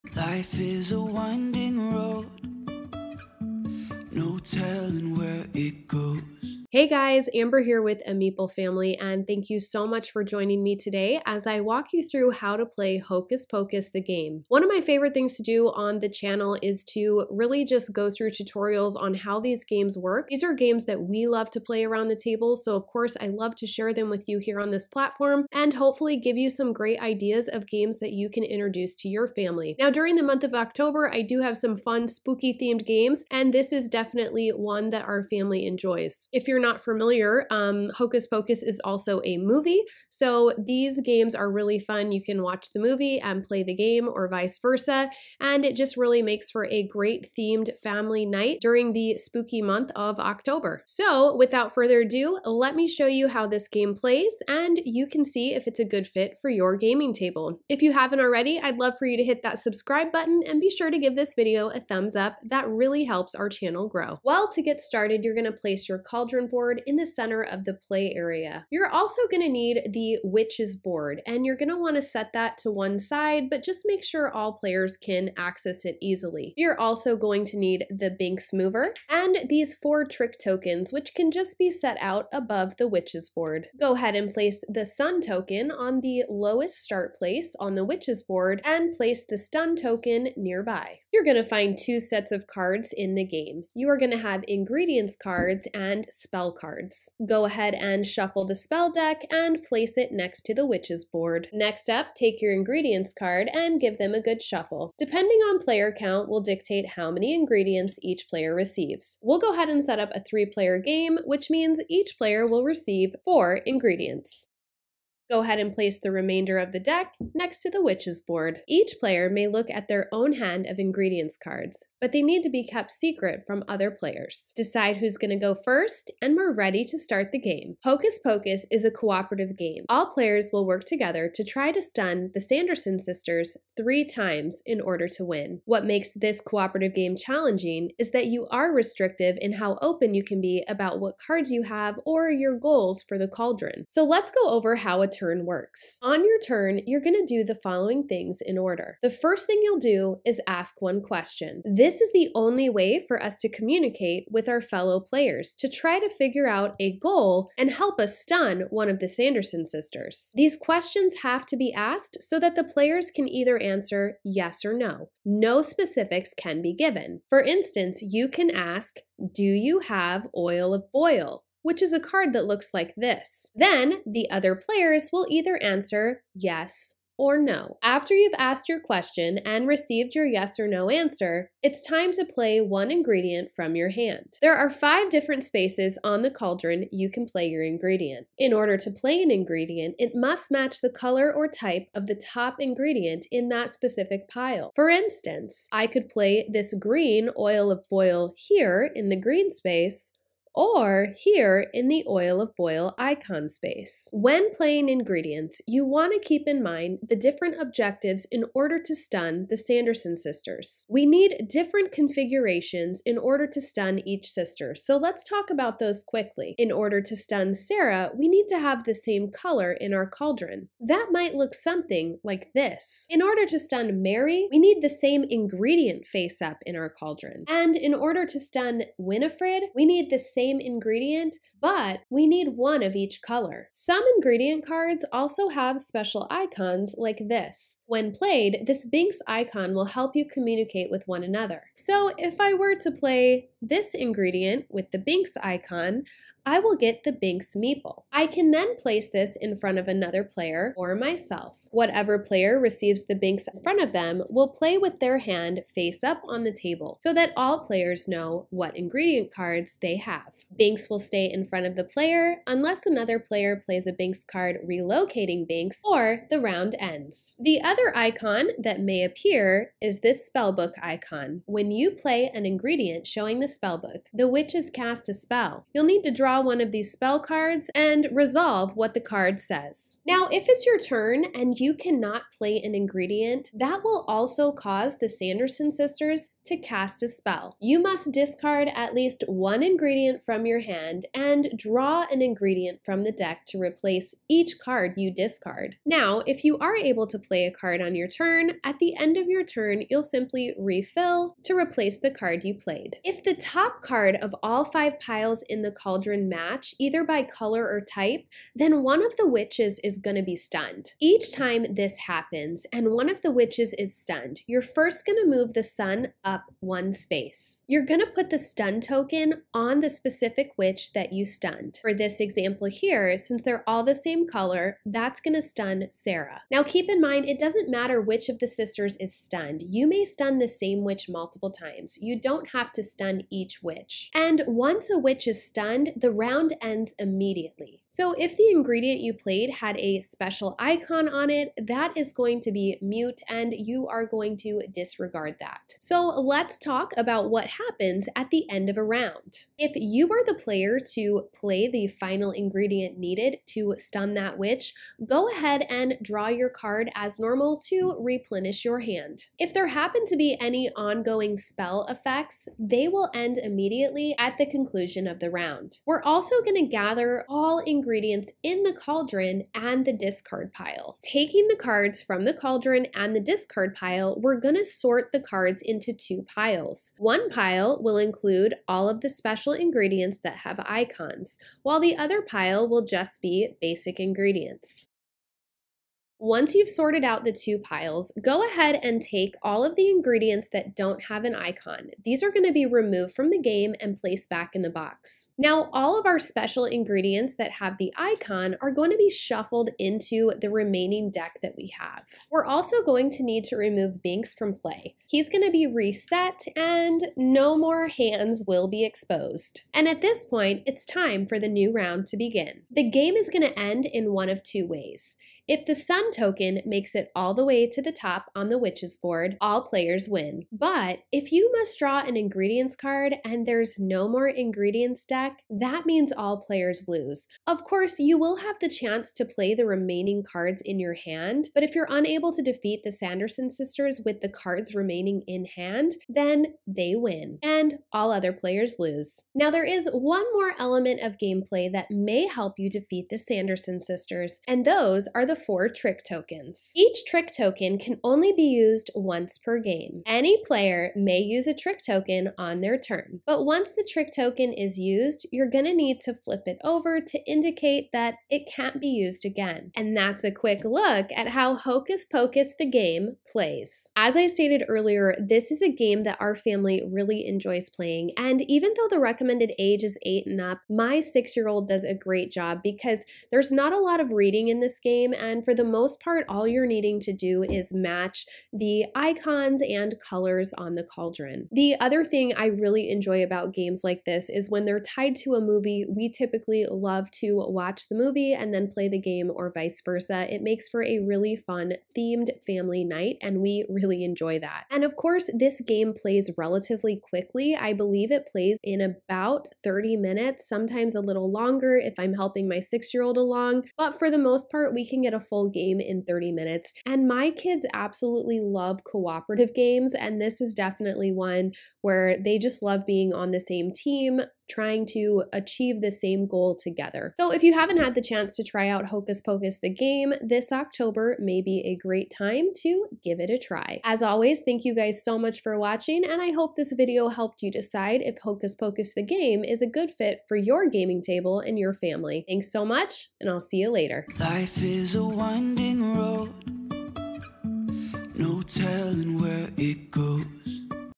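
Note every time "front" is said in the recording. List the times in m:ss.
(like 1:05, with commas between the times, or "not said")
4:09, 4:13, 4:21.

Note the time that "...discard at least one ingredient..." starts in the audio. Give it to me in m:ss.
4:48.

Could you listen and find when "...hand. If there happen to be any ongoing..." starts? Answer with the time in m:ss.
5:58.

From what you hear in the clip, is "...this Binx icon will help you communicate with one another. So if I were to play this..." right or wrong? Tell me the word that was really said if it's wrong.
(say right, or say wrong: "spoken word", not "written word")
right.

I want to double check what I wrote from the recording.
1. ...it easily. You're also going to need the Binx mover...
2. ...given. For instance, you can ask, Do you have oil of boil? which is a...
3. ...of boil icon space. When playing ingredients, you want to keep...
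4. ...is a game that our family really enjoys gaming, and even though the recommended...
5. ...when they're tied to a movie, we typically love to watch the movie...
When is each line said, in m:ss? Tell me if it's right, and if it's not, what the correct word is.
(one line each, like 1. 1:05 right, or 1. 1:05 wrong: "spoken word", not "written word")
1. 1:15 right
2. 2:46 right
3. 3:22 right
4. 7:45 wrong: "playing", not "gaming"
5. 8:04 right.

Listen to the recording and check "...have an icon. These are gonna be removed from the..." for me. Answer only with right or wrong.
right.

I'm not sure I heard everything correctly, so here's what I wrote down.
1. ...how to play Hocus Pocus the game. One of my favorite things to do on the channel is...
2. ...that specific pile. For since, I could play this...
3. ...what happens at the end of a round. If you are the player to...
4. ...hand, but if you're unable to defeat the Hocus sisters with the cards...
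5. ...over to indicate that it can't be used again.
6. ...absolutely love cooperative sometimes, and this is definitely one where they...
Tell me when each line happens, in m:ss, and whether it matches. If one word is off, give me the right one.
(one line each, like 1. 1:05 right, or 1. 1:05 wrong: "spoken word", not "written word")
1. 0:12 right
2. 3:13 wrong: "instance", not "since"
3. 5:47 right
4. 7:10 wrong: "Sanderson", not "Hocus"
5. 7:36 right
6. 8:27 wrong: "games", not "sometimes".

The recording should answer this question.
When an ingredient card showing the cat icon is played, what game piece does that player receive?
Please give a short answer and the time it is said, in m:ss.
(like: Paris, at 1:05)
Binx meeple, at 4:07.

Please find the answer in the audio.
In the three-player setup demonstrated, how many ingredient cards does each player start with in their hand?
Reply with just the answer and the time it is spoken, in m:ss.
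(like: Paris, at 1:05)
4, at 1:53.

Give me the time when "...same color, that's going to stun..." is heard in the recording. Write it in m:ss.
5:23.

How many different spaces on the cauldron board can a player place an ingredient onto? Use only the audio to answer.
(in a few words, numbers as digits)
5.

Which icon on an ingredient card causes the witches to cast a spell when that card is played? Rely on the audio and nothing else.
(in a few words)
spellbook icon.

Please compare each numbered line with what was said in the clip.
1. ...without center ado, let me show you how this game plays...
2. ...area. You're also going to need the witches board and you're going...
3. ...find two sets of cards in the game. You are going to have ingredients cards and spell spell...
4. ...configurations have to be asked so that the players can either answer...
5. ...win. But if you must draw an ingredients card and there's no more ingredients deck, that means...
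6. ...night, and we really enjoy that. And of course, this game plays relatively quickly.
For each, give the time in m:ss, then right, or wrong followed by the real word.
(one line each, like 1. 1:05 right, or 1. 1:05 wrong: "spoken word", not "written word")
1. 0:51 wrong: "further", not "center"
2. 1:08 right
3. 1:31 right
4. 2:40 wrong: "questions", not "configurations"
5. 7:00 right
6. 8:12 right.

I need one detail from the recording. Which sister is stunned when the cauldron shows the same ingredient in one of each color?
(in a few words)
Winifred.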